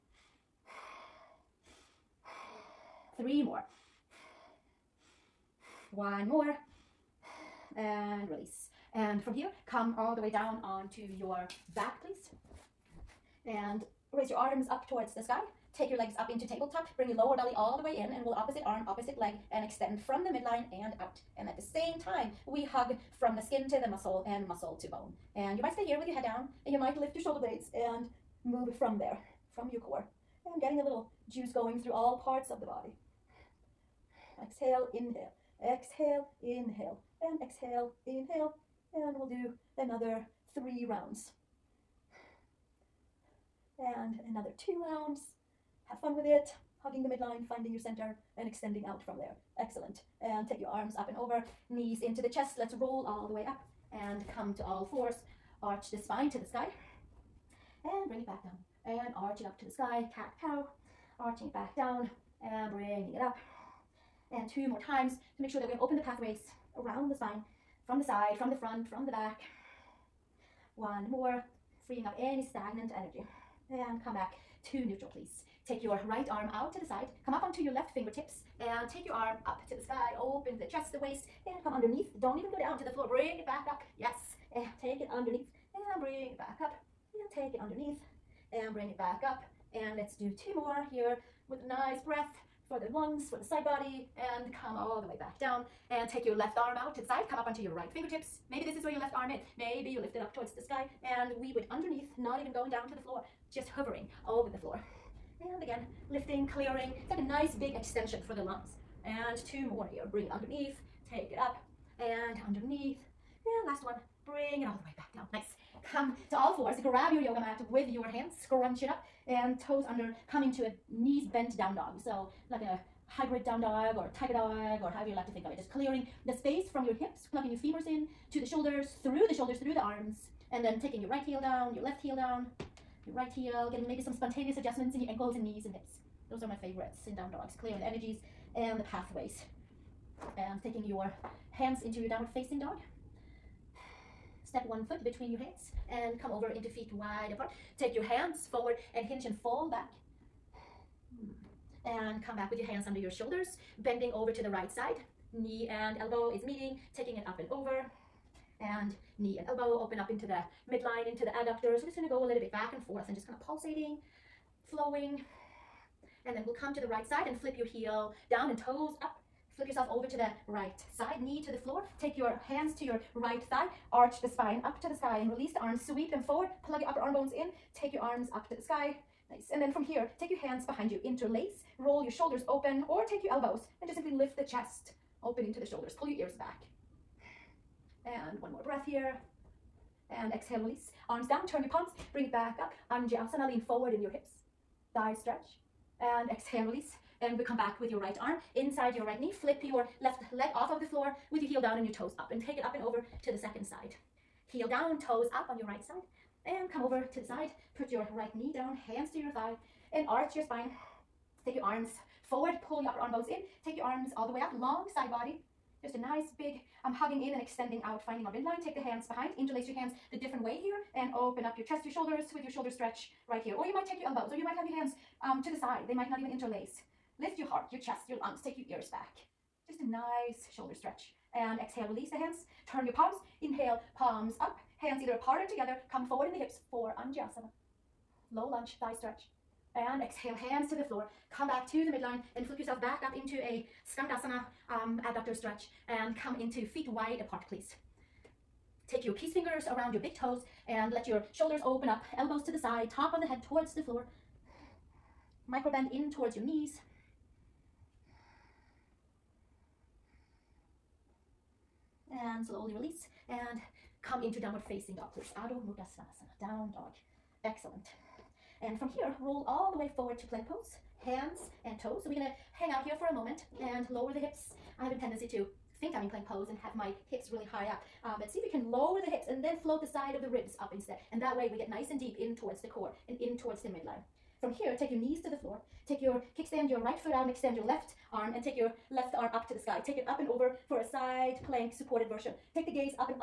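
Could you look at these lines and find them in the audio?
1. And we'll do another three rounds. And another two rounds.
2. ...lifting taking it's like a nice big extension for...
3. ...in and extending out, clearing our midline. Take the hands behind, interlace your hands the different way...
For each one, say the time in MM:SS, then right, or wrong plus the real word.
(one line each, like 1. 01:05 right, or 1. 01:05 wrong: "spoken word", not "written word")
1. 00:38 right
2. 01:46 wrong: "clearing", not "taking"
3. 03:37 wrong: "finding", not "clearing".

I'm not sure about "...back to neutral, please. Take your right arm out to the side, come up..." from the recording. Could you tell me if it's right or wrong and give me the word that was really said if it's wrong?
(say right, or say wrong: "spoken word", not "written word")
right.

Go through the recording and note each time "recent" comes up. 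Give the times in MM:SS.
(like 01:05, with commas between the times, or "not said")
not said.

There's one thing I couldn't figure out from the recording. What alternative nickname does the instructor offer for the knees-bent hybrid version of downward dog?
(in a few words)
tiger dog.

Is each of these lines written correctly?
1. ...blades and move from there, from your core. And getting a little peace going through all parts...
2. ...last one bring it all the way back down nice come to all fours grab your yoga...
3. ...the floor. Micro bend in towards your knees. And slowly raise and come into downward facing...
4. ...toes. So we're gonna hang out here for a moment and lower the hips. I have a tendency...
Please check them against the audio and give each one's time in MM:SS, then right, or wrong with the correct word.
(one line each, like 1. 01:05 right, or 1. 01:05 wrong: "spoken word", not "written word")
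1. 00:27 wrong: "juice", not "peace"
2. 01:53 right
3. 04:13 wrong: "release", not "raise"
4. 04:31 right.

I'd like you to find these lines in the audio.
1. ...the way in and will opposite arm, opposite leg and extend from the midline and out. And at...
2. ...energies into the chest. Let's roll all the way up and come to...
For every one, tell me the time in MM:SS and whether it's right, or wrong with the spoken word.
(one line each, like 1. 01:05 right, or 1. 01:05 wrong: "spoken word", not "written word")
1. 00:17 right
2. 00:51 wrong: "knees", not "energies".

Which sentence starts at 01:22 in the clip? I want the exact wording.
Don't even go down to the floor.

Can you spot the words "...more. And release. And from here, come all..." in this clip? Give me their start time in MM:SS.
00:06.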